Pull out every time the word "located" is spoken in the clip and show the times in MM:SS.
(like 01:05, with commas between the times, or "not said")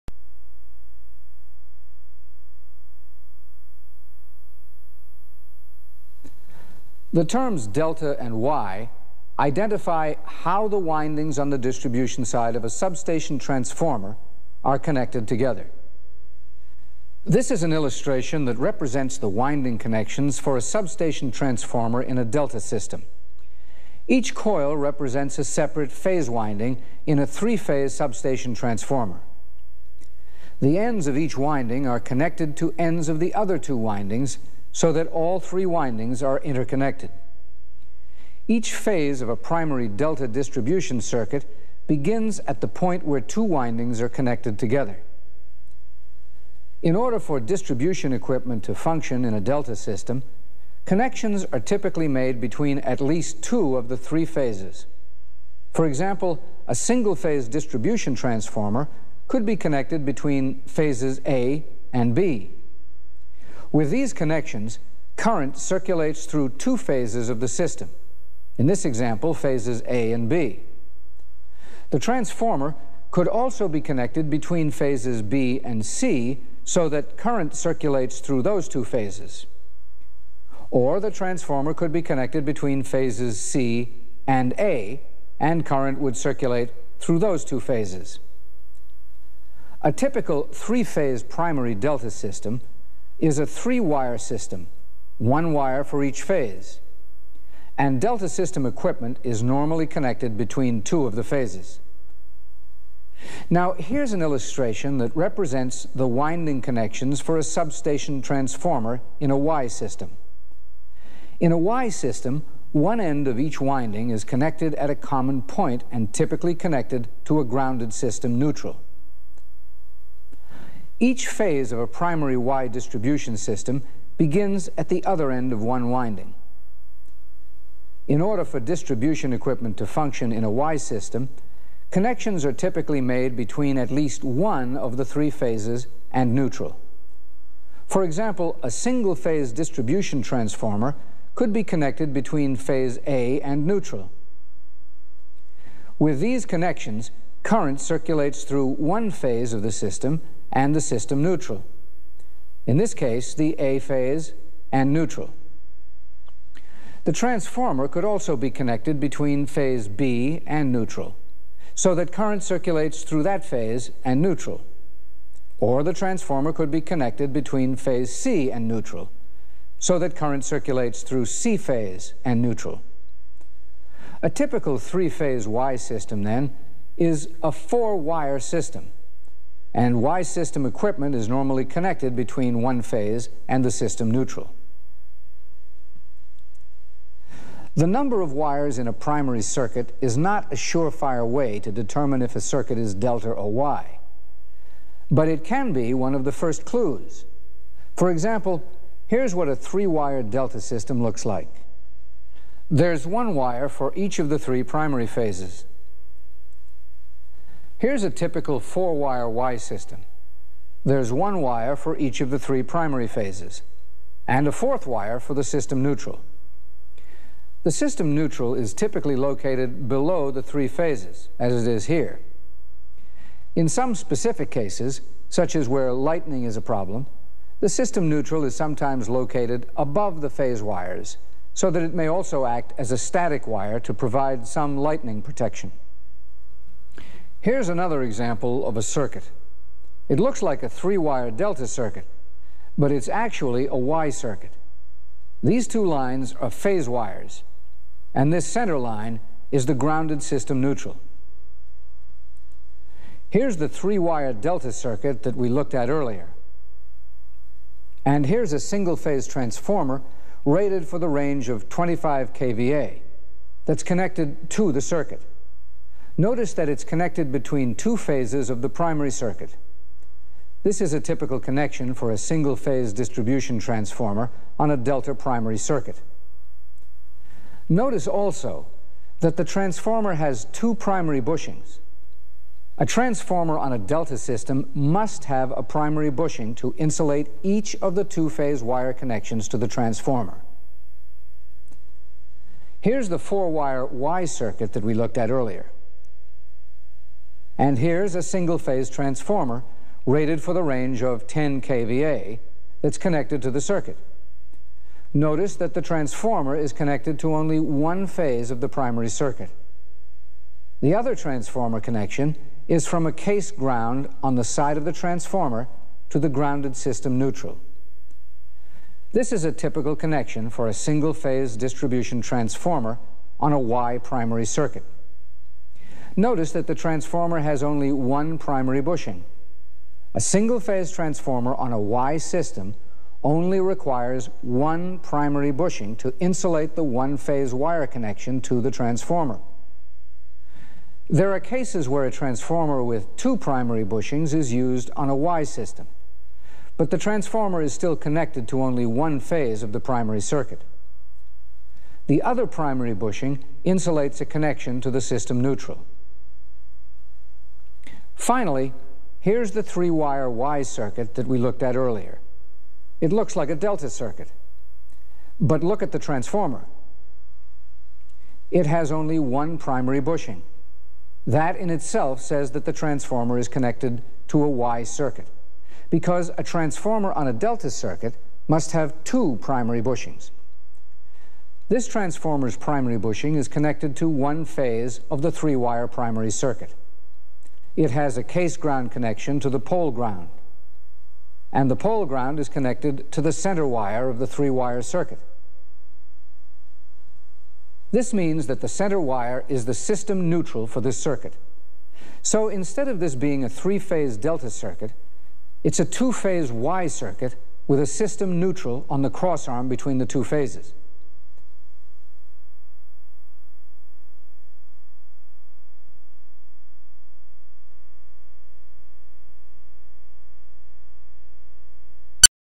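03:39, 03:49.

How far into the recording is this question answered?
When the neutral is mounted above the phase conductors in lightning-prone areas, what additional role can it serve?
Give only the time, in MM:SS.
03:52.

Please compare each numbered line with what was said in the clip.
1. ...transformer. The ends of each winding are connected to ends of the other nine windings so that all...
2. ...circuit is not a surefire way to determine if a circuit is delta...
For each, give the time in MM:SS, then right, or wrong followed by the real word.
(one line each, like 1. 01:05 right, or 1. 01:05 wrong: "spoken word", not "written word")
1. 00:28 wrong: "two", not "nine"
2. 03:09 right.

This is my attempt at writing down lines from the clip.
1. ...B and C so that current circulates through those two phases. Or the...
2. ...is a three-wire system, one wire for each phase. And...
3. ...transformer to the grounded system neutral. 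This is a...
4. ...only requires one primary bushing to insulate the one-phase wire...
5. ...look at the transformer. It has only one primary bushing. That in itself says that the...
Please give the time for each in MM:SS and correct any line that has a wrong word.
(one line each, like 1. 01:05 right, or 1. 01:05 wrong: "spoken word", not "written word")
1. 01:15 right
2. 01:33 right
3. 05:14 right
4. 05:33 right
5. 06:05 right.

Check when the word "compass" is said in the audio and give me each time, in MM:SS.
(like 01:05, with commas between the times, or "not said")
not said.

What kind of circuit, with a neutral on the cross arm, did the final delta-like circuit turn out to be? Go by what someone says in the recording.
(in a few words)
two-phase Y circuit.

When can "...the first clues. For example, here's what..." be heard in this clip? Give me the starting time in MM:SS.
03:16.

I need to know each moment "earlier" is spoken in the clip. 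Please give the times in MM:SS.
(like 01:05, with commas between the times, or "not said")
04:15, 04:55, 06:01.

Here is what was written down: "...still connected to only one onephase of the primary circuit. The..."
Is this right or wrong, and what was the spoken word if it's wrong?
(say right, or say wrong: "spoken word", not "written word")
wrong: "phase", not "onephase".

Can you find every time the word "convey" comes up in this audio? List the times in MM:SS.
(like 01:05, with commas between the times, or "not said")
not said.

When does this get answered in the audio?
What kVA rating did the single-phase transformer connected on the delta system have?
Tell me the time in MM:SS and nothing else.
04:21.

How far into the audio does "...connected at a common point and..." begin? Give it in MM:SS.
01:54.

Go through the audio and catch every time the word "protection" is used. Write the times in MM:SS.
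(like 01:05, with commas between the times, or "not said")
03:55.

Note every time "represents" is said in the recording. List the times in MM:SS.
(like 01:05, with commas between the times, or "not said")
00:18, 00:24, 01:45.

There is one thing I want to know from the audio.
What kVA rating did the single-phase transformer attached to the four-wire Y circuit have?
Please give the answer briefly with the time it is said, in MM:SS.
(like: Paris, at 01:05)
10 kVA, at 05:01.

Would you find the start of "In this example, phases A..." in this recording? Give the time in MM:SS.
01:08.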